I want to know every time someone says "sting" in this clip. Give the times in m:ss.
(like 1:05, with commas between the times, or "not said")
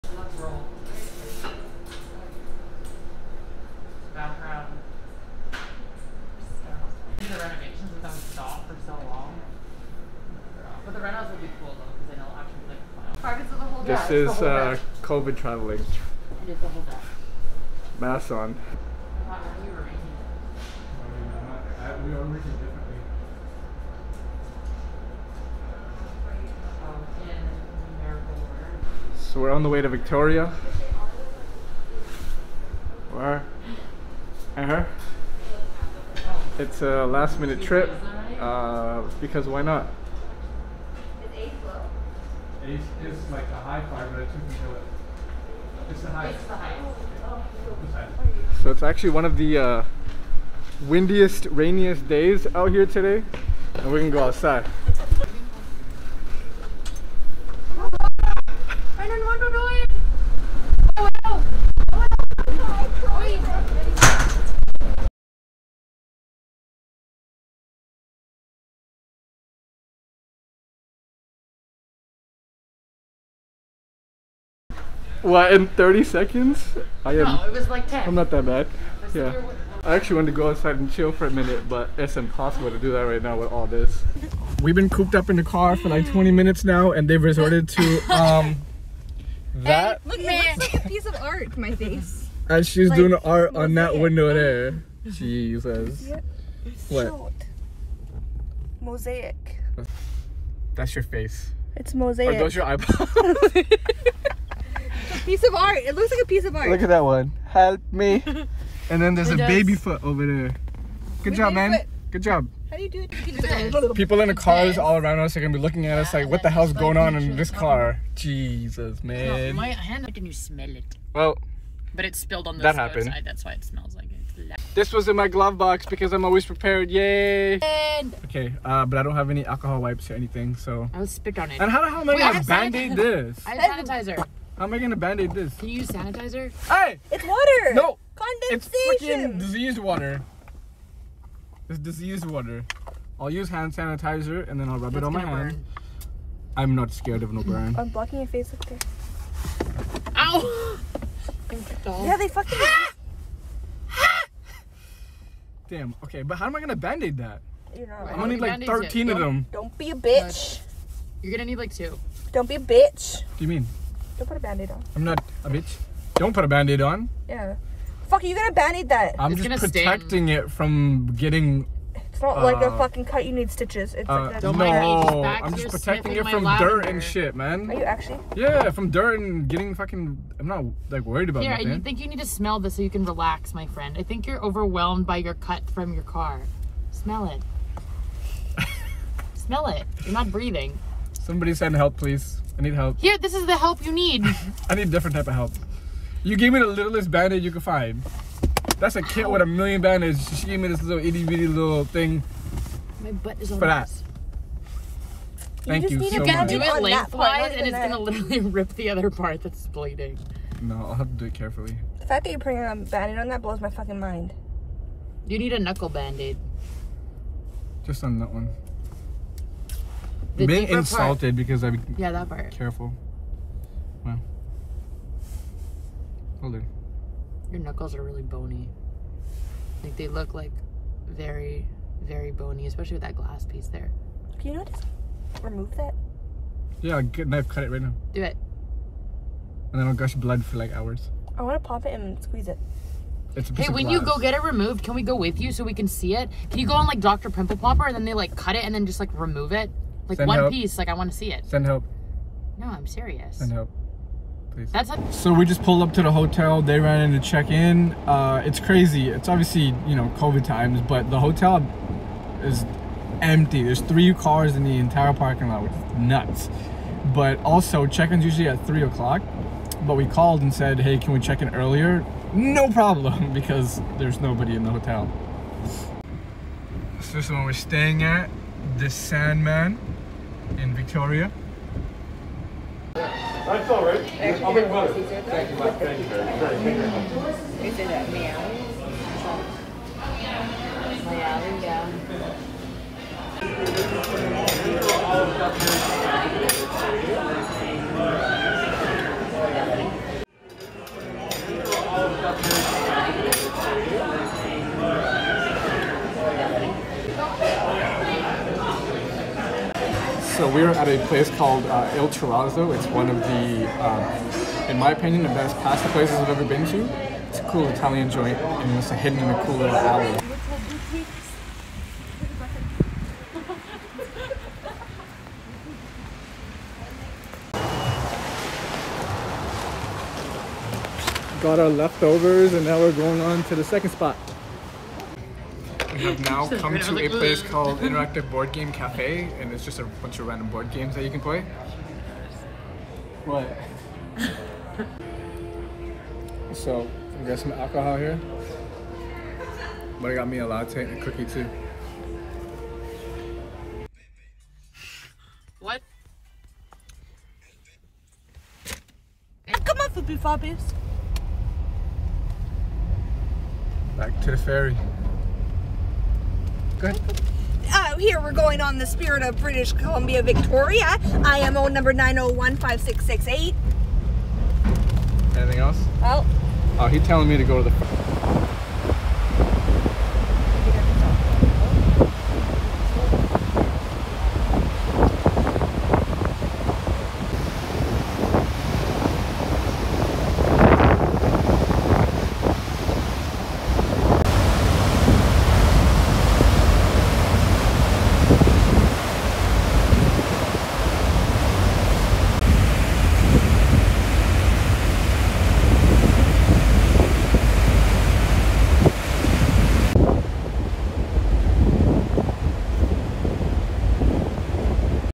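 2:49.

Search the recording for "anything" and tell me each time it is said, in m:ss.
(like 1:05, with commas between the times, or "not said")
2:10, 6:15.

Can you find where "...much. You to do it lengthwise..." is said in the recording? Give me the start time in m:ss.
3:26.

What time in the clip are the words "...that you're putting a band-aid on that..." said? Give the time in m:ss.
3:32.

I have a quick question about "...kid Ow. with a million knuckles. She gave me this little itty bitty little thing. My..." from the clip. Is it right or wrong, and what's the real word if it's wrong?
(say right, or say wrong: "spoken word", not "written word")
wrong: "bandages", not "knuckles".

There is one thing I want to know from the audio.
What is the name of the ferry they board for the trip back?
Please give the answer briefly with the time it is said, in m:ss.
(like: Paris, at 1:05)
Spirit of British Columbia, at 6:08.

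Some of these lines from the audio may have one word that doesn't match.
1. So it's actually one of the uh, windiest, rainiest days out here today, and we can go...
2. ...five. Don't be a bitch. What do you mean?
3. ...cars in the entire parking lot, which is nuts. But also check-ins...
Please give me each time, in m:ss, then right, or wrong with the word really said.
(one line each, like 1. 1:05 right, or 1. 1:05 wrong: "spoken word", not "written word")
1. 0:48 right
2. 2:41 wrong: "two", not "five"
3. 4:24 right.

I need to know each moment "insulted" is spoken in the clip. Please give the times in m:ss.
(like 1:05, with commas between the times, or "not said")
3:40.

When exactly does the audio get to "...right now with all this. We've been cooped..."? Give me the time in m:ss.
1:23.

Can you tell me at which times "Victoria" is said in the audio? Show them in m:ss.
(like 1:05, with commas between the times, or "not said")
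0:29, 4:40, 6:10.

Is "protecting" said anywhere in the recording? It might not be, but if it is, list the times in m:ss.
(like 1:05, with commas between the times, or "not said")
2:49, 2:55.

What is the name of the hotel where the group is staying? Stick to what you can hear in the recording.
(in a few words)
Sandman.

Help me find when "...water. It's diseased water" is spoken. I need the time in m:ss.
2:19.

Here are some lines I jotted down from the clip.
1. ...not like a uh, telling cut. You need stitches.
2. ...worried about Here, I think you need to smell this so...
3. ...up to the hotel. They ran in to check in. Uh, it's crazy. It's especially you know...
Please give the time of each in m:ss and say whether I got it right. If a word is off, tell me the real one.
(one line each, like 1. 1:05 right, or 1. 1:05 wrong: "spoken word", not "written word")
1. 2:52 wrong: "fucking", not "telling"
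2. 3:01 right
3. 4:15 wrong: "obviously", not "especially".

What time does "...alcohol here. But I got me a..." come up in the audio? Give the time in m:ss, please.
5:47.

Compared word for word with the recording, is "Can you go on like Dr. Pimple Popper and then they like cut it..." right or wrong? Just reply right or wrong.
right.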